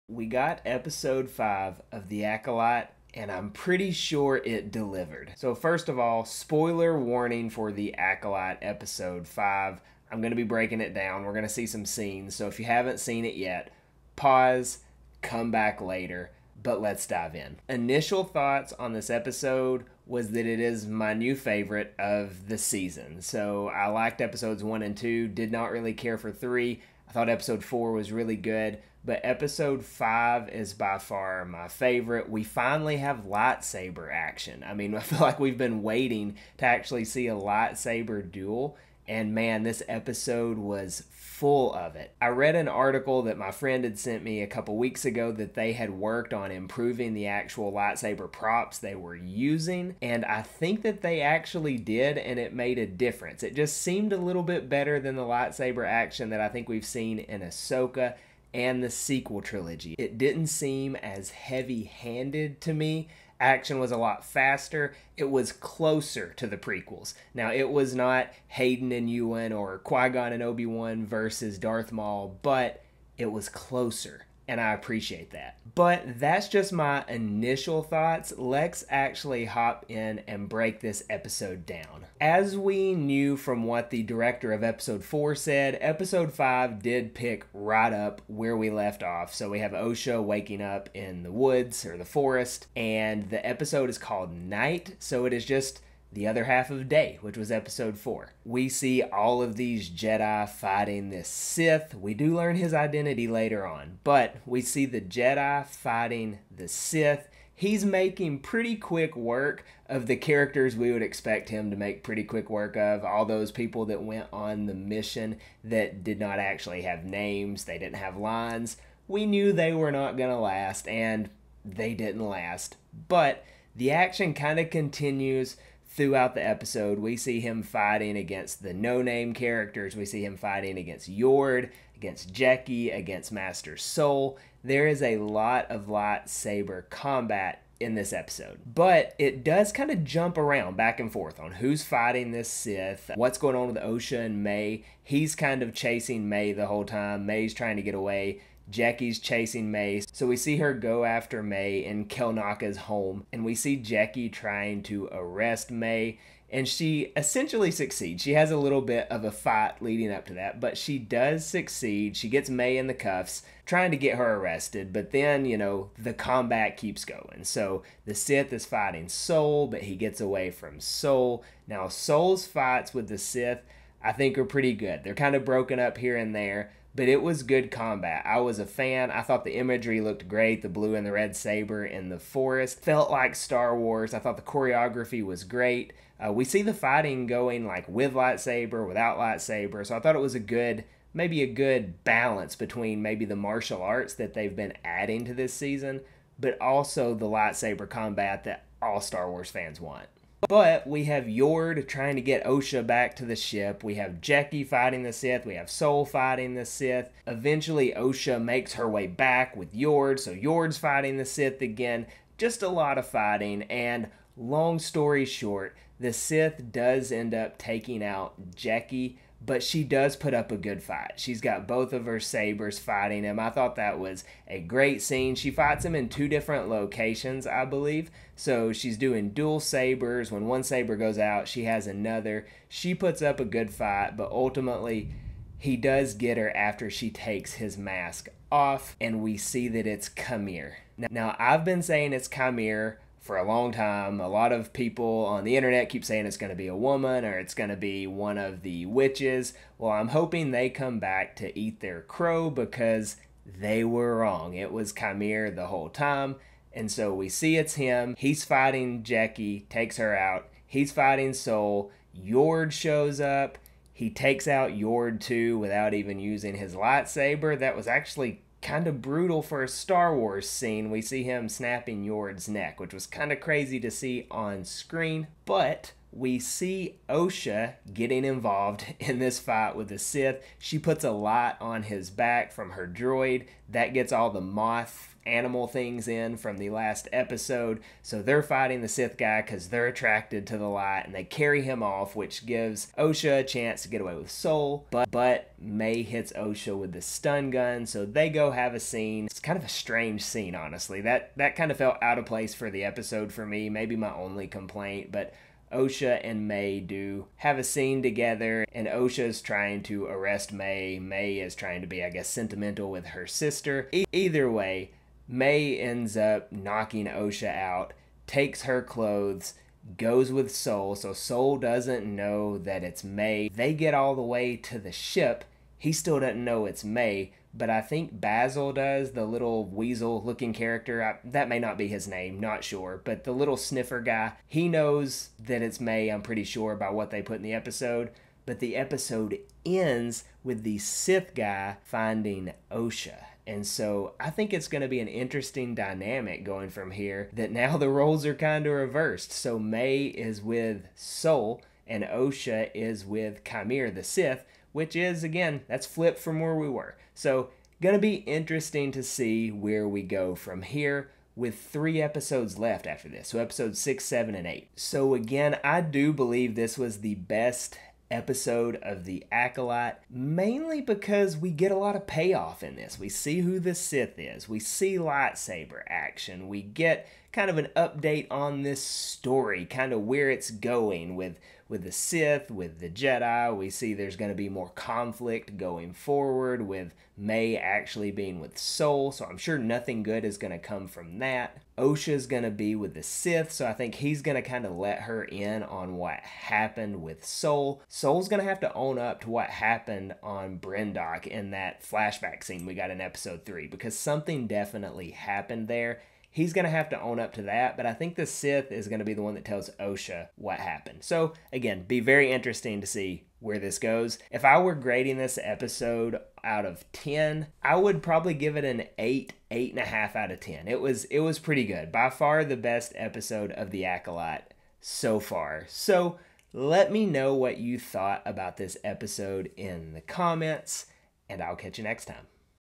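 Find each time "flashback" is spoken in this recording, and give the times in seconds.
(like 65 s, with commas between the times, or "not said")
401 s.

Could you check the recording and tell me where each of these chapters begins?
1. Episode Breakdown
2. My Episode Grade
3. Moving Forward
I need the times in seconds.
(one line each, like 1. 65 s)
1. 82 s
2. 414 s
3. 357 s.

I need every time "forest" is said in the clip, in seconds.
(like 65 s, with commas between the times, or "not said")
92 s, 182 s.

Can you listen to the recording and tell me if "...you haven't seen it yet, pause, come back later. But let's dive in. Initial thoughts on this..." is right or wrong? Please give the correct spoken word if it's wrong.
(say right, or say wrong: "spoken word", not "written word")
right.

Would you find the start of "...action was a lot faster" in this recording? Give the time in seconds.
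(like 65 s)
63 s.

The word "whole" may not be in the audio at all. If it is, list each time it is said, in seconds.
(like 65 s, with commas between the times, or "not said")
146 s, 255 s.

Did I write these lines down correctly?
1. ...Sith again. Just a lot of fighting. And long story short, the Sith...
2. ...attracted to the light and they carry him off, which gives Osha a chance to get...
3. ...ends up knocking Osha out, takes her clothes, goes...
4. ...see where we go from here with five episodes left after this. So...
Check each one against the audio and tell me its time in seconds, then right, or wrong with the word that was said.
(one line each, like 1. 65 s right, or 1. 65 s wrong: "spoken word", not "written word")
1. 211 s right
2. 289 s right
3. 315 s right
4. 359 s wrong: "three", not "five".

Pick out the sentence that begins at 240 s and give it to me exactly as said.
Now, I've been saying it's Qimir for a long time.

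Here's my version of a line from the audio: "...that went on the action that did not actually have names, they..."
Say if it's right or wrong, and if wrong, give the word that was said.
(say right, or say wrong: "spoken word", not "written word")
wrong: "mission", not "action".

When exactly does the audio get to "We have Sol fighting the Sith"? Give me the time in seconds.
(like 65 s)
205 s.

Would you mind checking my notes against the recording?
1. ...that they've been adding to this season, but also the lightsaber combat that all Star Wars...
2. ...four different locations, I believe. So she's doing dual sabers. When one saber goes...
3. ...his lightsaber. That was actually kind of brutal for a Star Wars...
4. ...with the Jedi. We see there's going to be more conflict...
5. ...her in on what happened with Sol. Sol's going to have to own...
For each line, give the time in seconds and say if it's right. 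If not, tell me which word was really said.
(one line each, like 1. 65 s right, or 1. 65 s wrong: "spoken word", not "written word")
1. 194 s right
2. 226 s wrong: "two", not "four"
3. 266 s right
4. 382 s right
5. 395 s right.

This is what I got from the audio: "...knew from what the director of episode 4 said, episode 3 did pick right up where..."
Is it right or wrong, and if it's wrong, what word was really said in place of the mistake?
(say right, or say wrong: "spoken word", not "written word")
wrong: "5", not "3".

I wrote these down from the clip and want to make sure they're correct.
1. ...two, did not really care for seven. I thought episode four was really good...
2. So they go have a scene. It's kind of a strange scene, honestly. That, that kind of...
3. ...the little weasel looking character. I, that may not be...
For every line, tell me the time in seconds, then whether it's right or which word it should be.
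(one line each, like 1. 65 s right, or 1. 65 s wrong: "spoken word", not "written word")
1. 24 s wrong: "three", not "seven"
2. 297 s right
3. 329 s right.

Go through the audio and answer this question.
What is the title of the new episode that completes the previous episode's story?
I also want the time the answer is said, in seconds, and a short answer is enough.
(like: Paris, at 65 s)
Night, at 94 s.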